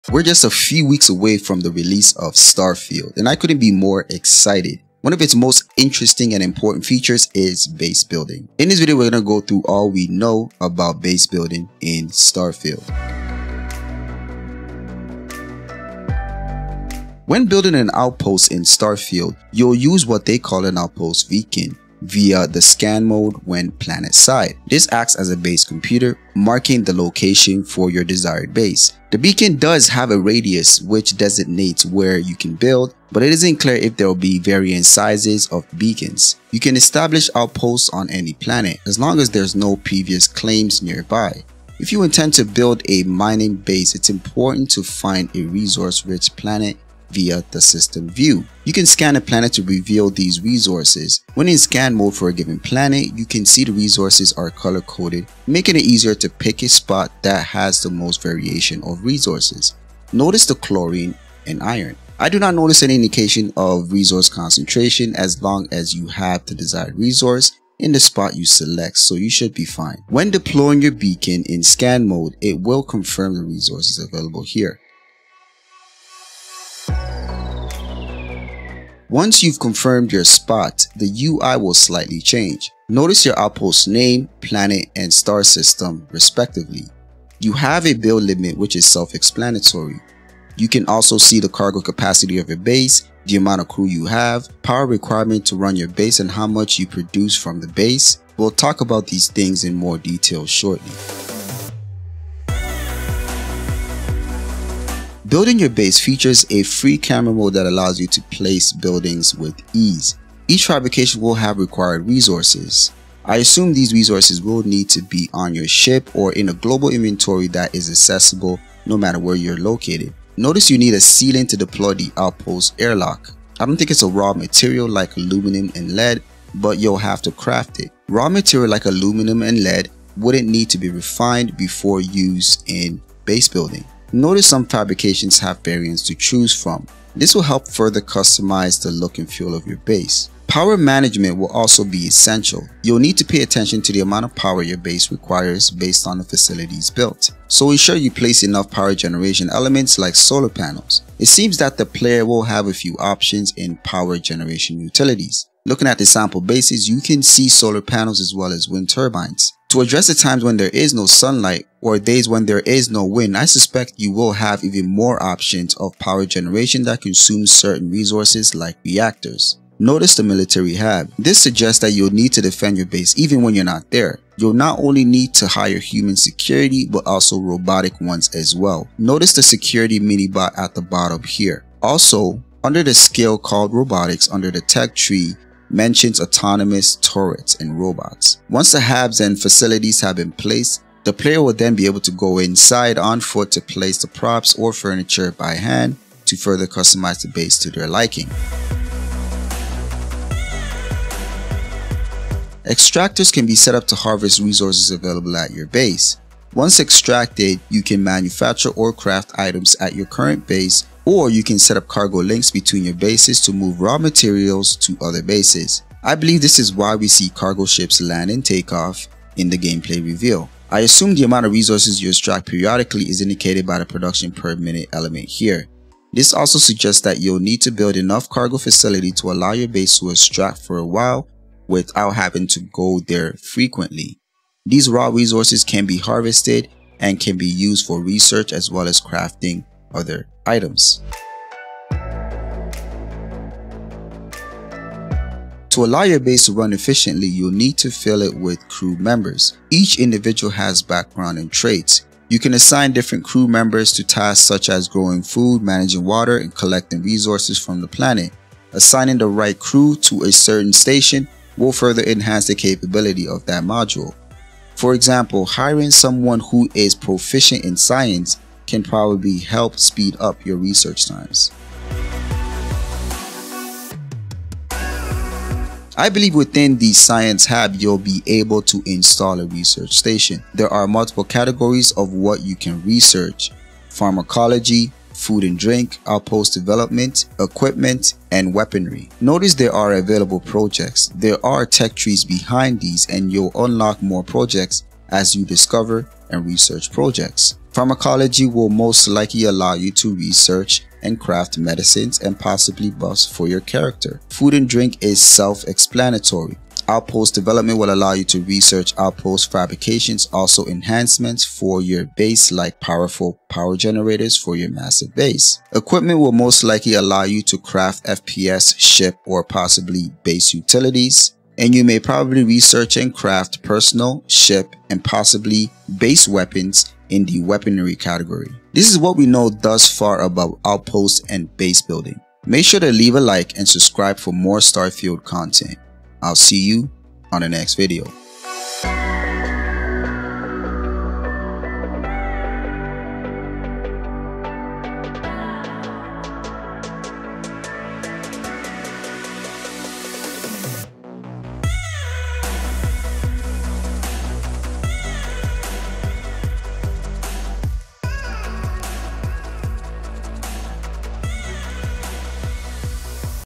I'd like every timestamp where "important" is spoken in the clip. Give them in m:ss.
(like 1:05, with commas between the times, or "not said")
0:06, 0:44.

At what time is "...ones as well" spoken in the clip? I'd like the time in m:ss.
2:58.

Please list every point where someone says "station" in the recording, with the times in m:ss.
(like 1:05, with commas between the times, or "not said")
4:20, 4:39.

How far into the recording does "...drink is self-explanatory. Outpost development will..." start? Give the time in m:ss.
5:04.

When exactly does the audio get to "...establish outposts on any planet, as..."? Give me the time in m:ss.
0:36.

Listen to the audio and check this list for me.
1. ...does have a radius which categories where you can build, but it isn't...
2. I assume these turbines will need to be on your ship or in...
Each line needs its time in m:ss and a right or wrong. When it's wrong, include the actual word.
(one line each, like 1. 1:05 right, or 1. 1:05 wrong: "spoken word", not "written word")
1. 0:29 wrong: "designates", not "categories"
2. 1:53 wrong: "resources", not "turbines".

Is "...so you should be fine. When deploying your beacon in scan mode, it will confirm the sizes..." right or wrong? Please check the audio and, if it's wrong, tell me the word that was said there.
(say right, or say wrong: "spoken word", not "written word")
wrong: "resources", not "sizes".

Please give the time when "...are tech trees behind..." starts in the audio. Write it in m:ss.
4:51.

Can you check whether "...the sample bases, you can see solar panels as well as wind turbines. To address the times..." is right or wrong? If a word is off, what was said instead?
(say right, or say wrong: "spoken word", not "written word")
right.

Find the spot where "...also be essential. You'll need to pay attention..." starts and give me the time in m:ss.
2:21.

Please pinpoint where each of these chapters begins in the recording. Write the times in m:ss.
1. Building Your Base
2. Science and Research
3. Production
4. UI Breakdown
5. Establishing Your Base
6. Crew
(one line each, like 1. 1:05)
1. 1:44
2. 4:33
3. 3:19
4. 1:17
5. 0:13
6. 4:02.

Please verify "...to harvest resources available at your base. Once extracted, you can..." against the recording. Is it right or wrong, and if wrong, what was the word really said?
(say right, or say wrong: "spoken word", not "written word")
right.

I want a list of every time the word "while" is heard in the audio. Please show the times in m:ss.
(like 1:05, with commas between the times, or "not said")
3:50.